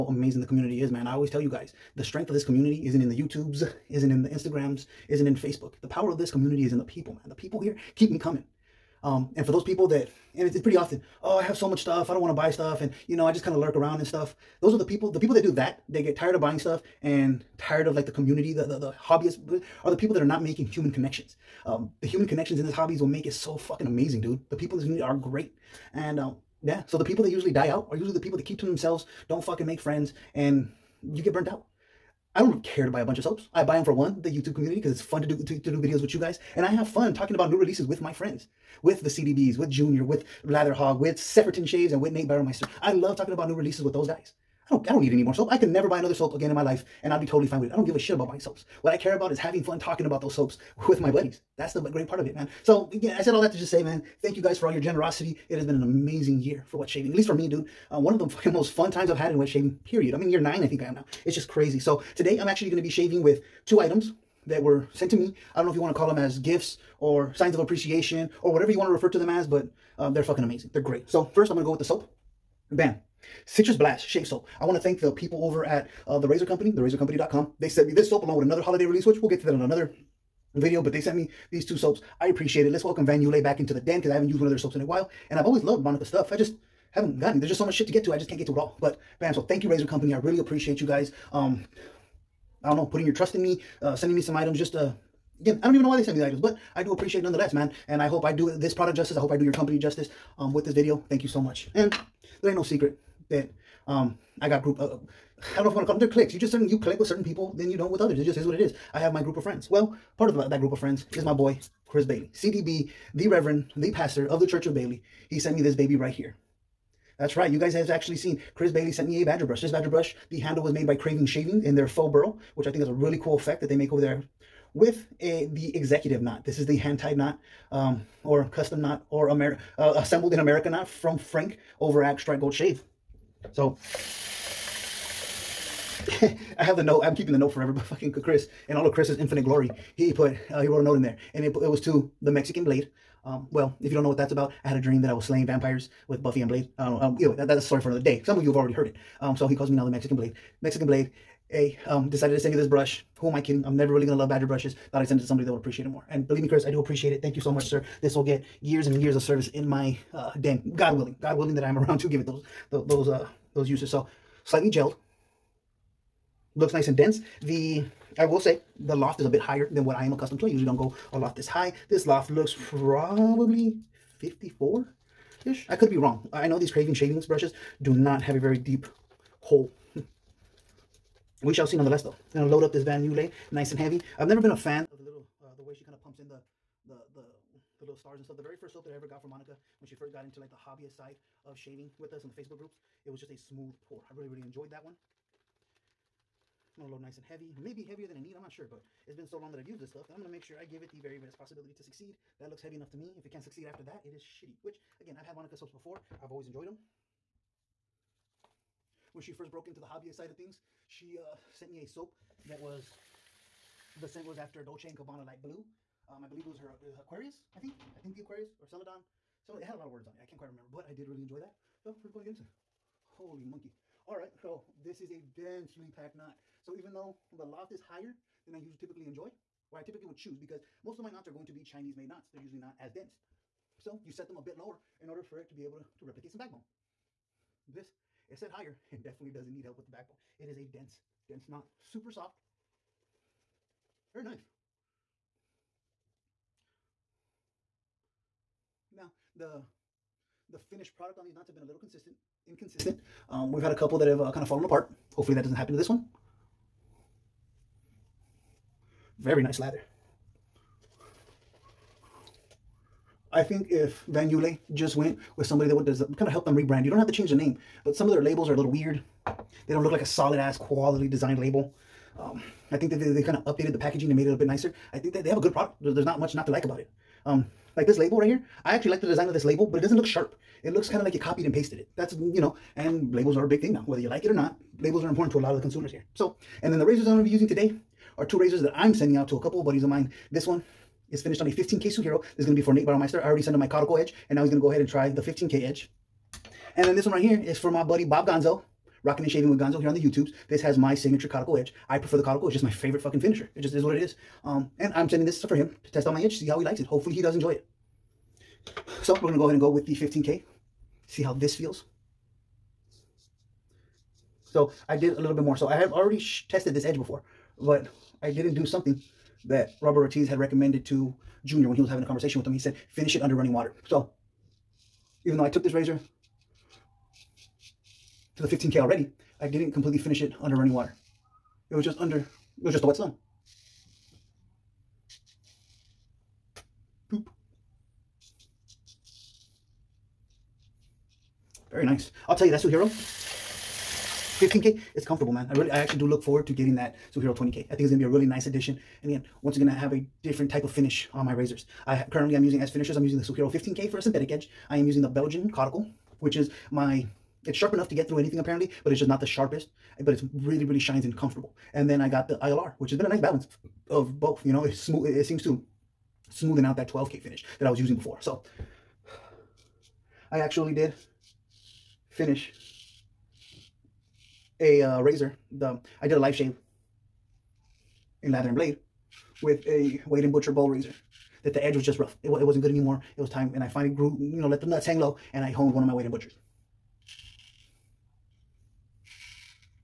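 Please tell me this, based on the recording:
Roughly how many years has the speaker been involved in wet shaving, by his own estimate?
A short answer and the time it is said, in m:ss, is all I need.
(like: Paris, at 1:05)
9, at 1:00.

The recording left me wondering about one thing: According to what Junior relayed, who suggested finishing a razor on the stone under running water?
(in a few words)
Robert Ortiz.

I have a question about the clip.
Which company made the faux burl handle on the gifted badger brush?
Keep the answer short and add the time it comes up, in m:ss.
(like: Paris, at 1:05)
Craving Shaving, at 2:00.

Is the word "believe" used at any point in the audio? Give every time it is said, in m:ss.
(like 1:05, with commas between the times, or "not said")
2:36, 3:36.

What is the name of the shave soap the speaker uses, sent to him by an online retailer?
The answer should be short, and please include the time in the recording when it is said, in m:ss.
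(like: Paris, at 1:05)
Citrus Blast, at 1:13.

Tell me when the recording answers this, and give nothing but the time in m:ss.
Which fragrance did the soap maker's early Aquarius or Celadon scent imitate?
3:34.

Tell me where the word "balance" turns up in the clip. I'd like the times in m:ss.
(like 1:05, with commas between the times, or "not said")
6:03.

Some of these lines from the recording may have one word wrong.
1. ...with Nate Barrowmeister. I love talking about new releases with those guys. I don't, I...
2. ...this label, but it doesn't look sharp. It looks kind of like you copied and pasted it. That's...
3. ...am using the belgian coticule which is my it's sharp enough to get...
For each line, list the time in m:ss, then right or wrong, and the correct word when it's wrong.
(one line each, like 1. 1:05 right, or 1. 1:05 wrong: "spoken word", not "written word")
1. 0:42 right
2. 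4:39 right
3. 5:54 right.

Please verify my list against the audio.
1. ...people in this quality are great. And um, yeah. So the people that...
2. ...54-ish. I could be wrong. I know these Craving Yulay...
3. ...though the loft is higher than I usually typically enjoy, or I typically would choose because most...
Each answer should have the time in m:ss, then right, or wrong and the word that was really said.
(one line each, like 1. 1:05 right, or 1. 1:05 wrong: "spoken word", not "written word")
1. 0:24 wrong: "community", not "quality"
2. 2:54 wrong: "Shavings", not "Yulay"
3. 3:46 right.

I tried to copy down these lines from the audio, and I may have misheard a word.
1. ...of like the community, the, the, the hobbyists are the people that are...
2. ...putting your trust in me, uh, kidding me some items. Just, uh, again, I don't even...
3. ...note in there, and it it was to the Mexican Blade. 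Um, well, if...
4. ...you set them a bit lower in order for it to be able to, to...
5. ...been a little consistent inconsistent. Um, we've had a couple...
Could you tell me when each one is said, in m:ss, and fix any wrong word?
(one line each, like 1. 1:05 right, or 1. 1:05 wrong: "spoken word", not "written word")
1. 0:17 right
2. 1:32 wrong: "sending", not "kidding"
3. 2:20 right
4. 3:54 right
5. 4:11 right.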